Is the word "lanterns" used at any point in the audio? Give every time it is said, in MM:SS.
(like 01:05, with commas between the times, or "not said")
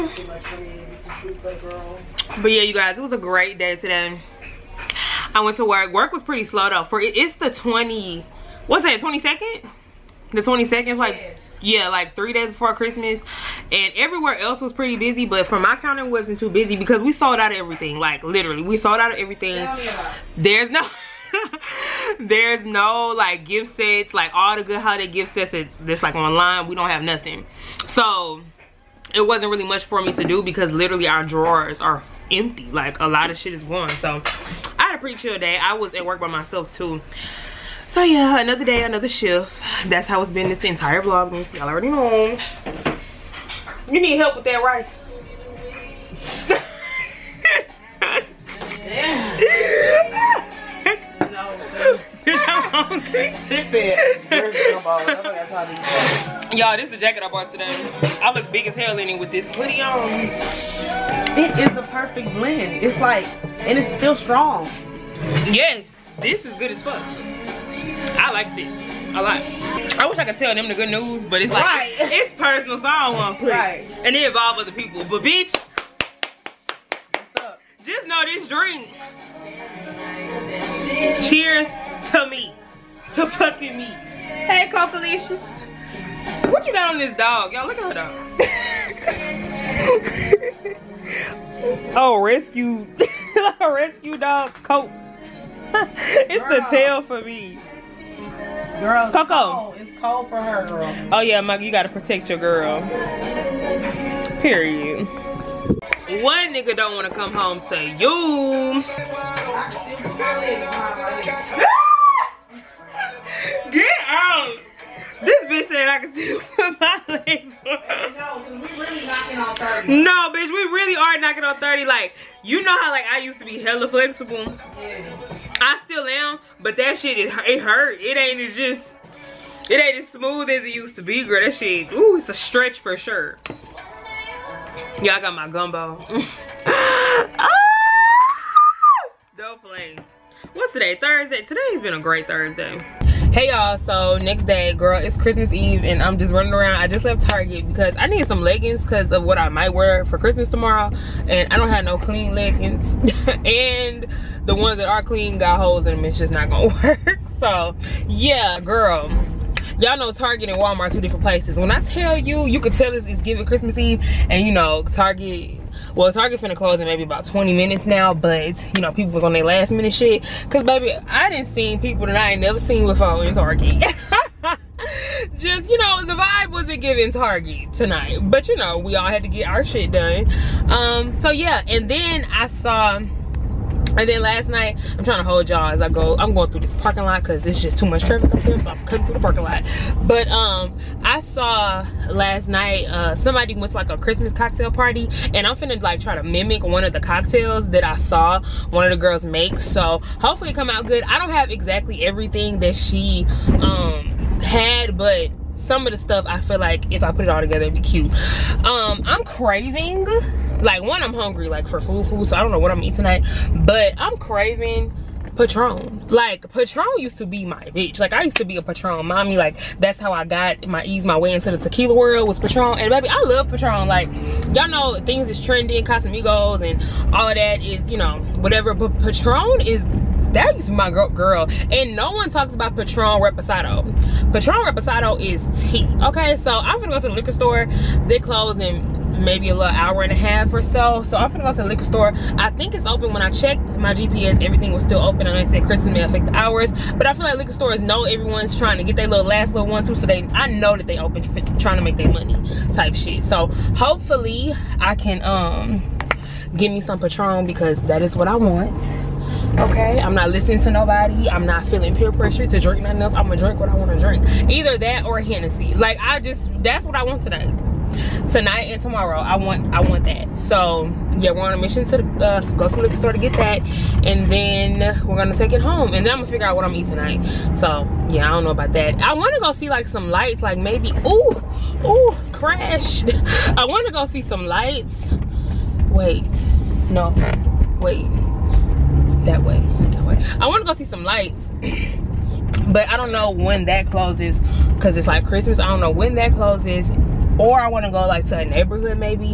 not said.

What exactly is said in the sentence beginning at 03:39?
Like that's how I got my ease my way into the tequila world was Patron.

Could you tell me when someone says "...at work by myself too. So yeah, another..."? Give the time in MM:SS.
00:35.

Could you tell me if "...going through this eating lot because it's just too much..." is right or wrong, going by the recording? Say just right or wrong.
wrong.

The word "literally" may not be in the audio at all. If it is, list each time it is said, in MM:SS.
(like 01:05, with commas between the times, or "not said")
00:18, 00:30.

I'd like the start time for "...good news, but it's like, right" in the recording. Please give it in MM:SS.
01:10.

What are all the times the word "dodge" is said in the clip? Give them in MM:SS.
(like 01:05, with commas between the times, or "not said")
not said.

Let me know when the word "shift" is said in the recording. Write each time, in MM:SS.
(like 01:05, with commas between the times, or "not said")
00:39.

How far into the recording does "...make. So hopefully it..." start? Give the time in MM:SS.
03:19.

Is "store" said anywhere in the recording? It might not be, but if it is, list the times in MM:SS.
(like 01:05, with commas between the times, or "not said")
03:57, 04:01, 04:07, 04:32.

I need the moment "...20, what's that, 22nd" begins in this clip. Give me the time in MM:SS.
00:07.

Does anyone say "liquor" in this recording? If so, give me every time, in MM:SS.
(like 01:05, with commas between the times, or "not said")
03:57, 04:01, 04:07, 04:32.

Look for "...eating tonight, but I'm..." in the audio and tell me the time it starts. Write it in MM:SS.
03:32.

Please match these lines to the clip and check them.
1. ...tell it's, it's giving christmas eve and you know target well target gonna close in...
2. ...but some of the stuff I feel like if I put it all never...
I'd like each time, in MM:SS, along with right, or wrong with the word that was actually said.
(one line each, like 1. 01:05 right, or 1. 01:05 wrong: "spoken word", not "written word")
1. 02:42 wrong: "finna", not "gonna"
2. 03:24 wrong: "together", not "never".